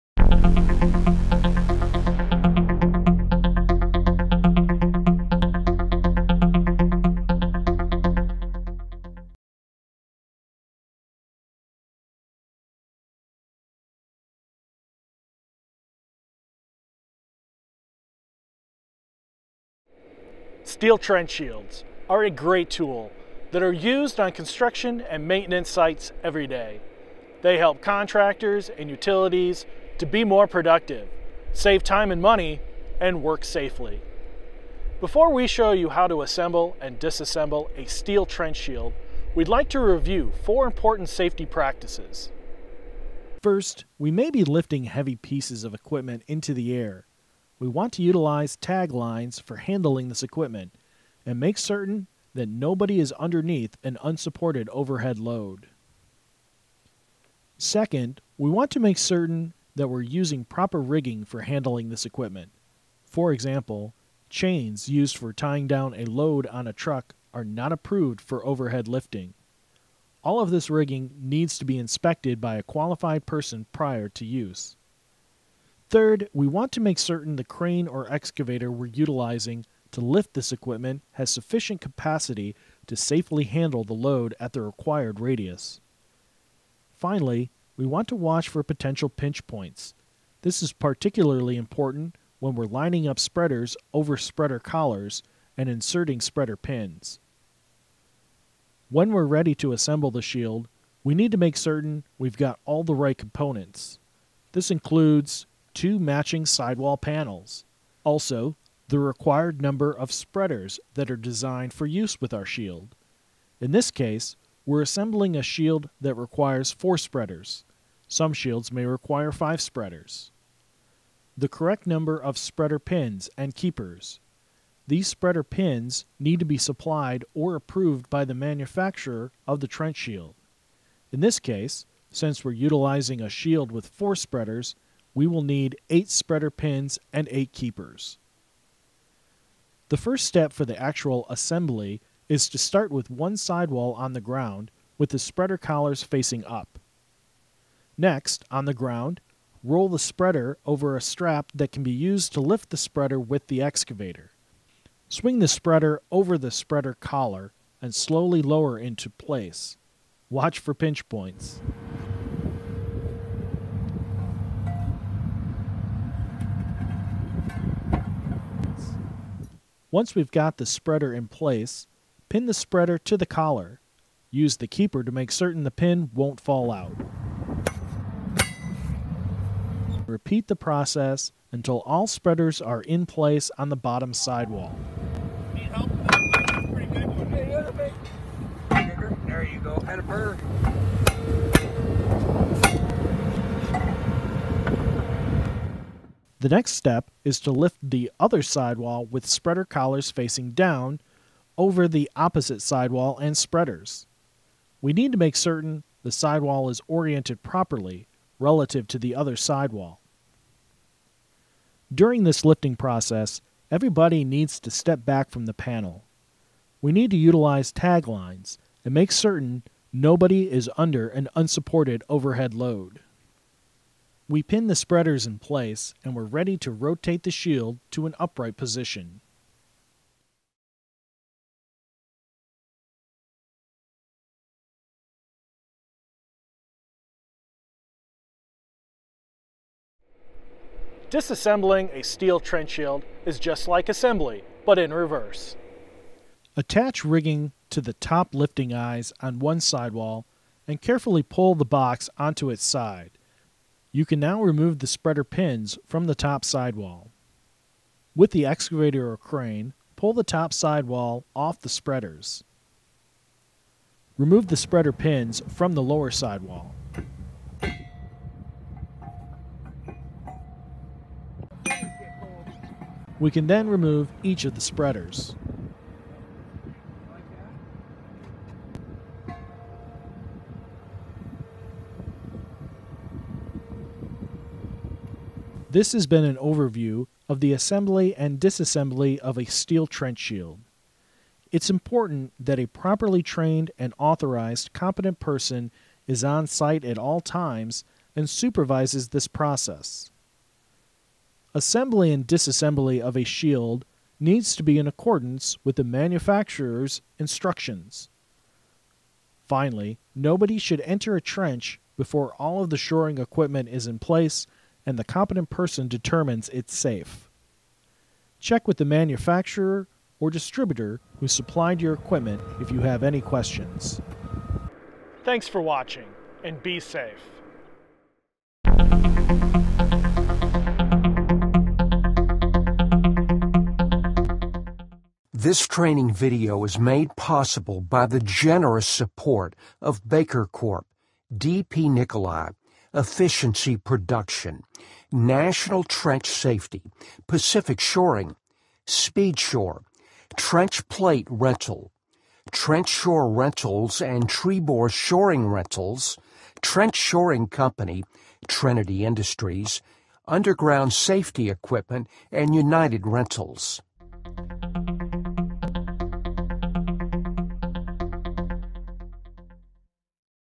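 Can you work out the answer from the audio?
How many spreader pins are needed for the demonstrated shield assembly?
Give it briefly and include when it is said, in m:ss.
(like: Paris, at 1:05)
8, at 2:15.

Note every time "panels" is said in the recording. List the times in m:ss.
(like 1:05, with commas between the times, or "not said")
1:46, 3:35.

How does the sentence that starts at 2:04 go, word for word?
These spreader pins need to be supplied or approved by the manufacturer of the trench shield.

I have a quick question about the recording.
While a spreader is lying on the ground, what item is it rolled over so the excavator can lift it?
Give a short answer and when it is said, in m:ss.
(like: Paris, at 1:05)
A strap, at 2:31.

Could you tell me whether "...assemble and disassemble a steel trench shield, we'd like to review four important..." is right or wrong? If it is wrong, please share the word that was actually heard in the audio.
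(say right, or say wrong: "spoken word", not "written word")
right.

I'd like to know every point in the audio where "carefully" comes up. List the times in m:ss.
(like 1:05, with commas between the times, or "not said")
4:10.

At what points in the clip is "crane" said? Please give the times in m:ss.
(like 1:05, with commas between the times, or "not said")
1:17, 4:19.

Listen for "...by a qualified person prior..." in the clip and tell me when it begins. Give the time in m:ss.
1:12.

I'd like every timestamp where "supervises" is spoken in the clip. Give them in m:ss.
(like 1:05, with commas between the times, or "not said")
4:58.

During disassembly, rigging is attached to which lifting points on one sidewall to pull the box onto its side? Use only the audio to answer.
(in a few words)
Top lifting eyes.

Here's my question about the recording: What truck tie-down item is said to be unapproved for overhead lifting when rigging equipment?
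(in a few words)
Chains.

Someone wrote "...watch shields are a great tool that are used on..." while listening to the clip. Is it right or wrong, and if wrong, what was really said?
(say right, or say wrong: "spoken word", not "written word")
wrong: "trench", not "watch".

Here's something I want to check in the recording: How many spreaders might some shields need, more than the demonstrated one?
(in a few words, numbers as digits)
5.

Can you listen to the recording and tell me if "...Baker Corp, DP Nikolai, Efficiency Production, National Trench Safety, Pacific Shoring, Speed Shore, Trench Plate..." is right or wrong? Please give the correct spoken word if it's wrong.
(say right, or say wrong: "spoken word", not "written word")
right.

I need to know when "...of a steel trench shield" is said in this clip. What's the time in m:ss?
4:49.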